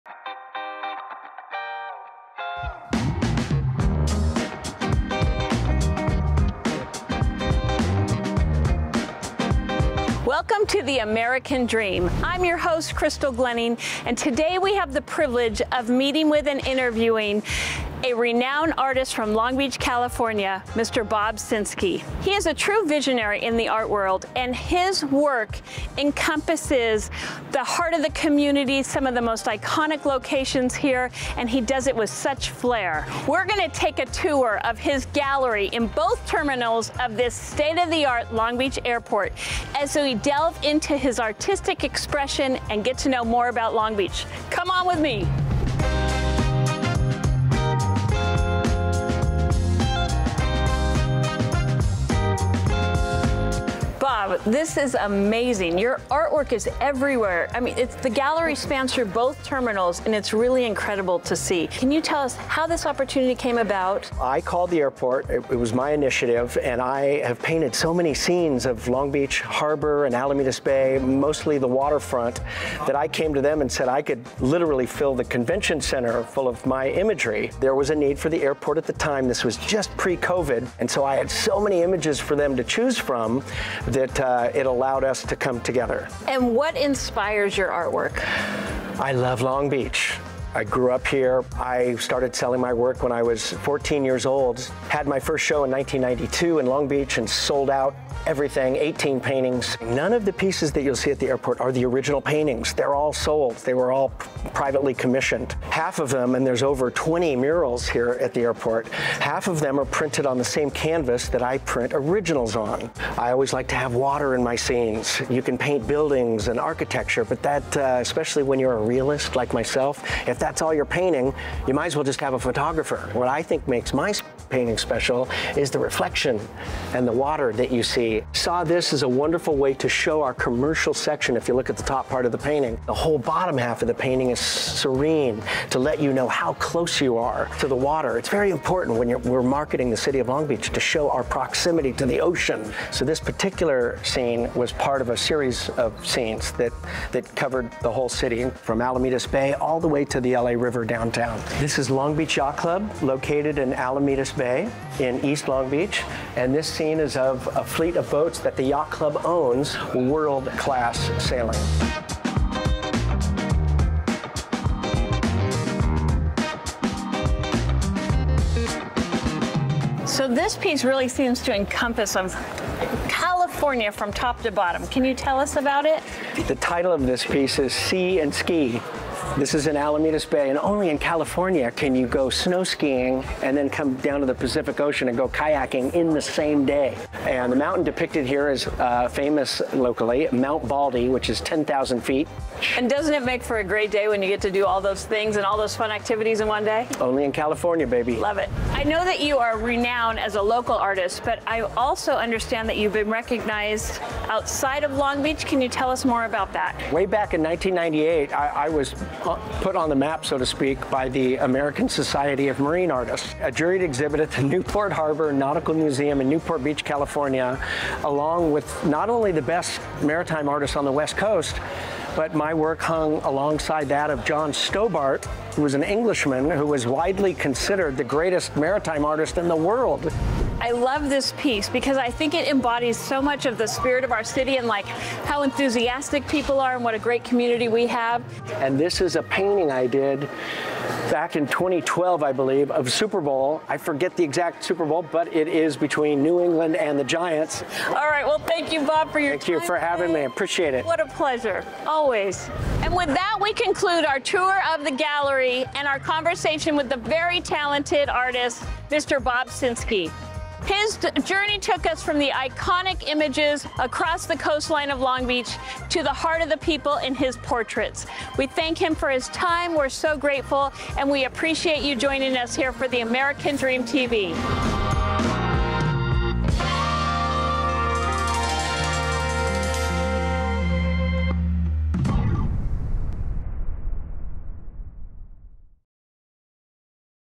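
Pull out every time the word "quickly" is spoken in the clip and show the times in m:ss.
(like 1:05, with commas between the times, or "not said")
not said.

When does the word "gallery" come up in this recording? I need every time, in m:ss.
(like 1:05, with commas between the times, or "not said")
0:35, 0:58, 4:14.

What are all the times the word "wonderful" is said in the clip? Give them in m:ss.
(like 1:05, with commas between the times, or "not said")
2:09.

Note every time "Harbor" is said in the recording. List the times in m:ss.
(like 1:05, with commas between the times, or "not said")
1:09, 3:34.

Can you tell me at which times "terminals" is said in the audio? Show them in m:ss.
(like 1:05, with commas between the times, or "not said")
0:36, 0:59.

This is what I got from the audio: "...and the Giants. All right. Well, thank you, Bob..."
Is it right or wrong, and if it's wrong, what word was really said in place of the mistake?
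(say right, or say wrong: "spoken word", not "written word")
right.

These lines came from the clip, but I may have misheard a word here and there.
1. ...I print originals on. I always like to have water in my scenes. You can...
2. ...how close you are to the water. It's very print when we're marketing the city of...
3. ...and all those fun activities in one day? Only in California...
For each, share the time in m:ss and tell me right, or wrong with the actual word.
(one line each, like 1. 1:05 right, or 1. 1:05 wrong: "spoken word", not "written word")
1. 1:51 right
2. 2:16 wrong: "important", not "print"
3. 3:15 right.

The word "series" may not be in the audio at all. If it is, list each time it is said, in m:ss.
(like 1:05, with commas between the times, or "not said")
2:25.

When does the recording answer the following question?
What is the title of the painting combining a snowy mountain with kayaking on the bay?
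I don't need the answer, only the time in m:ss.
2:57.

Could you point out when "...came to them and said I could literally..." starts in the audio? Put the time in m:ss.
1:13.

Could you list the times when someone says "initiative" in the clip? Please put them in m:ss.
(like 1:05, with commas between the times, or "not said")
1:05.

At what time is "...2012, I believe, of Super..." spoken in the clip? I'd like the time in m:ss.
4:01.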